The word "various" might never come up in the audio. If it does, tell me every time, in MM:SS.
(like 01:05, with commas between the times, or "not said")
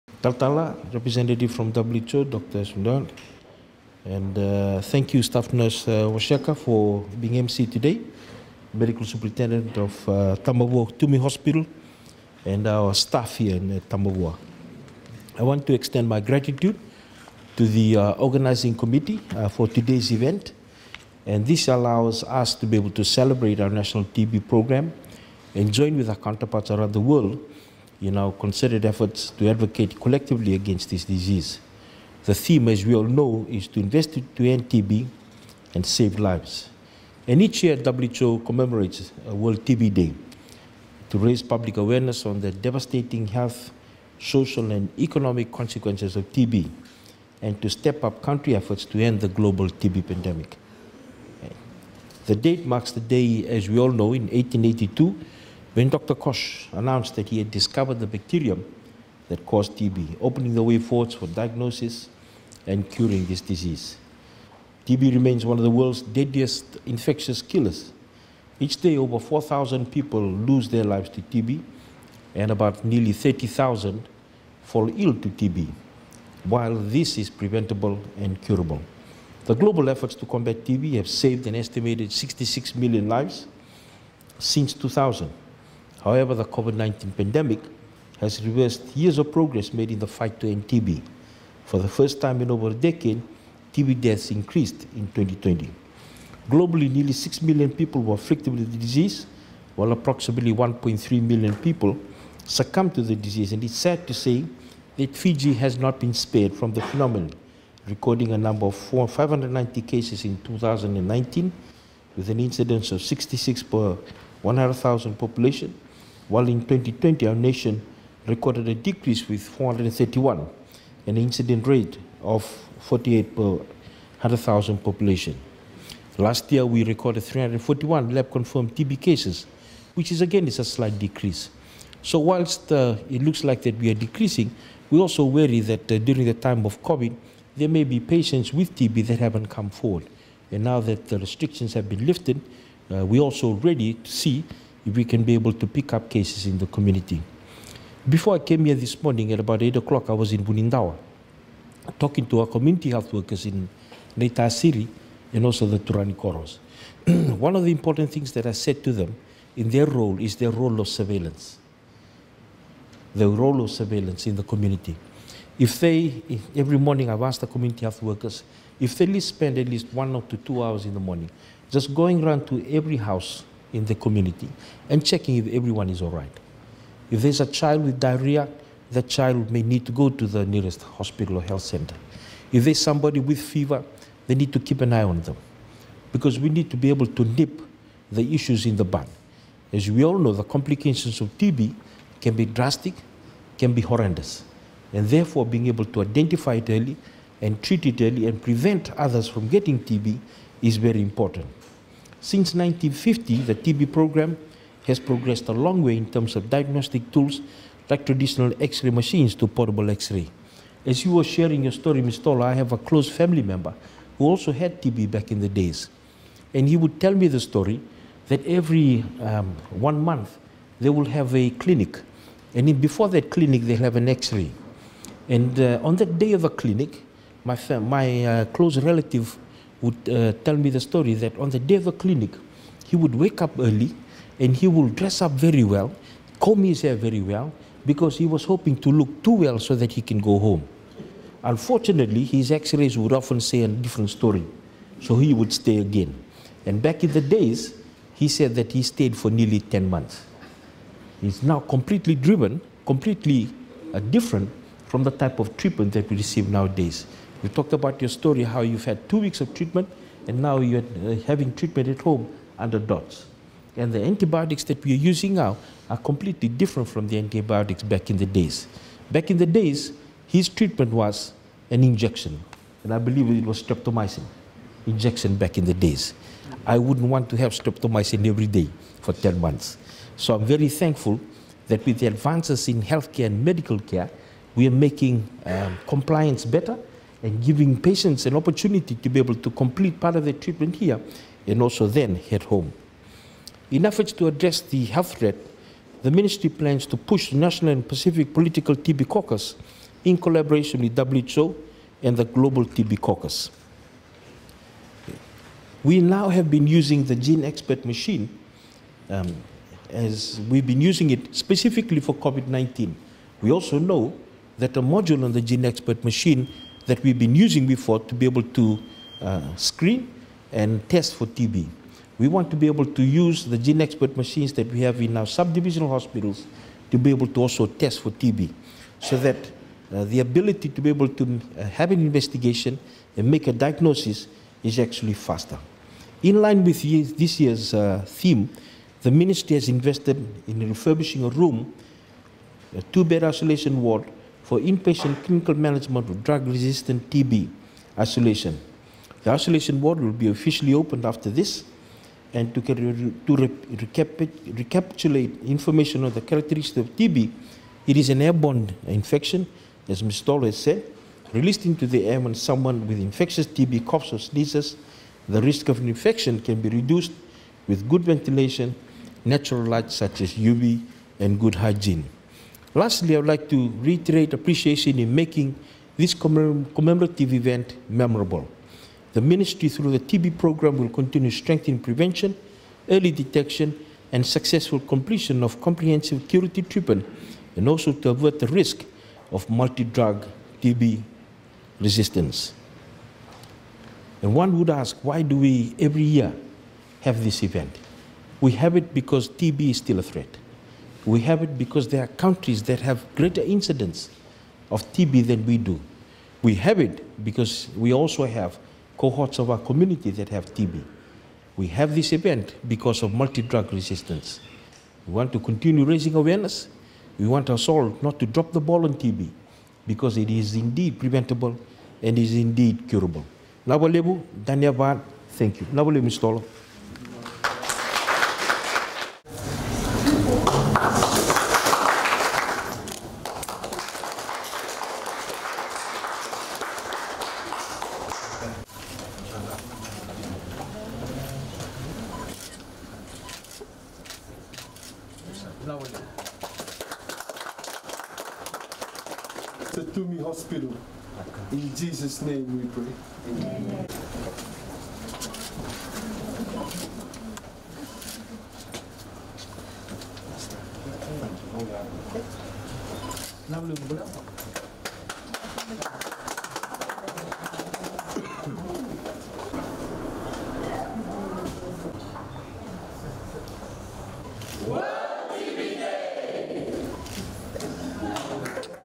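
not said.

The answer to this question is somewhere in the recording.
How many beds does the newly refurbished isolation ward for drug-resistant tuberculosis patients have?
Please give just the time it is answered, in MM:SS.
05:42.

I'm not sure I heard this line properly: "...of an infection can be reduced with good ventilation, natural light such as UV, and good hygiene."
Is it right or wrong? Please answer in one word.
right.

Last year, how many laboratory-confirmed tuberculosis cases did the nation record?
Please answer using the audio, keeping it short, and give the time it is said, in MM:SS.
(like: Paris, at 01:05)
341, at 02:07.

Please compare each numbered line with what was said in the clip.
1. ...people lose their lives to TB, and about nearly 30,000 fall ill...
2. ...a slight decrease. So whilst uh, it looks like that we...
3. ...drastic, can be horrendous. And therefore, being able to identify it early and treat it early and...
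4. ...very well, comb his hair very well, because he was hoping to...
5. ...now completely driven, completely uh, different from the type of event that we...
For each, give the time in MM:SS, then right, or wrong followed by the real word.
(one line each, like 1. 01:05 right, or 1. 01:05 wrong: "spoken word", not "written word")
1. 01:09 right
2. 02:10 right
3. 03:12 right
4. 03:55 right
5. 04:11 wrong: "treatment", not "event".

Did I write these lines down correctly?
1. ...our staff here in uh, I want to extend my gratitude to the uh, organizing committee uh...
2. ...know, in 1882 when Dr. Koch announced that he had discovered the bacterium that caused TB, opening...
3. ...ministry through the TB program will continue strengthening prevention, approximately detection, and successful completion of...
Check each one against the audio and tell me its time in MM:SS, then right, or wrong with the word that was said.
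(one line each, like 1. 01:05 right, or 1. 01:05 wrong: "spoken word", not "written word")
1. 00:12 right
2. 00:53 right
3. 06:19 wrong: "early", not "approximately".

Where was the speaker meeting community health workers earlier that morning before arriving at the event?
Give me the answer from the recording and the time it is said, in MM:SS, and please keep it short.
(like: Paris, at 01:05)
Bunindawa, at 02:30.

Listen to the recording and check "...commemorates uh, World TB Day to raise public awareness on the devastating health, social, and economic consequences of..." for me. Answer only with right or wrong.
right.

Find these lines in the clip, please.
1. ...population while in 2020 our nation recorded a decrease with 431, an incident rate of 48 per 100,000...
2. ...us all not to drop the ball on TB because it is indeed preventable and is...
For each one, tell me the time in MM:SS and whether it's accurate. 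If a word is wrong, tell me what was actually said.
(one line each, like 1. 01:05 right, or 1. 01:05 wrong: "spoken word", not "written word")
1. 01:55 right
2. 06:57 right.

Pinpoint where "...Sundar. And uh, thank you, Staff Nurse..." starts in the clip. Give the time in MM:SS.
00:02.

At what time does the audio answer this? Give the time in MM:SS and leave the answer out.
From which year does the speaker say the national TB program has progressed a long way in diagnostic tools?
03:22.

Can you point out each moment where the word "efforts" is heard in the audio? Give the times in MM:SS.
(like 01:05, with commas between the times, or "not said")
00:28, 00:48, 01:19, 04:53.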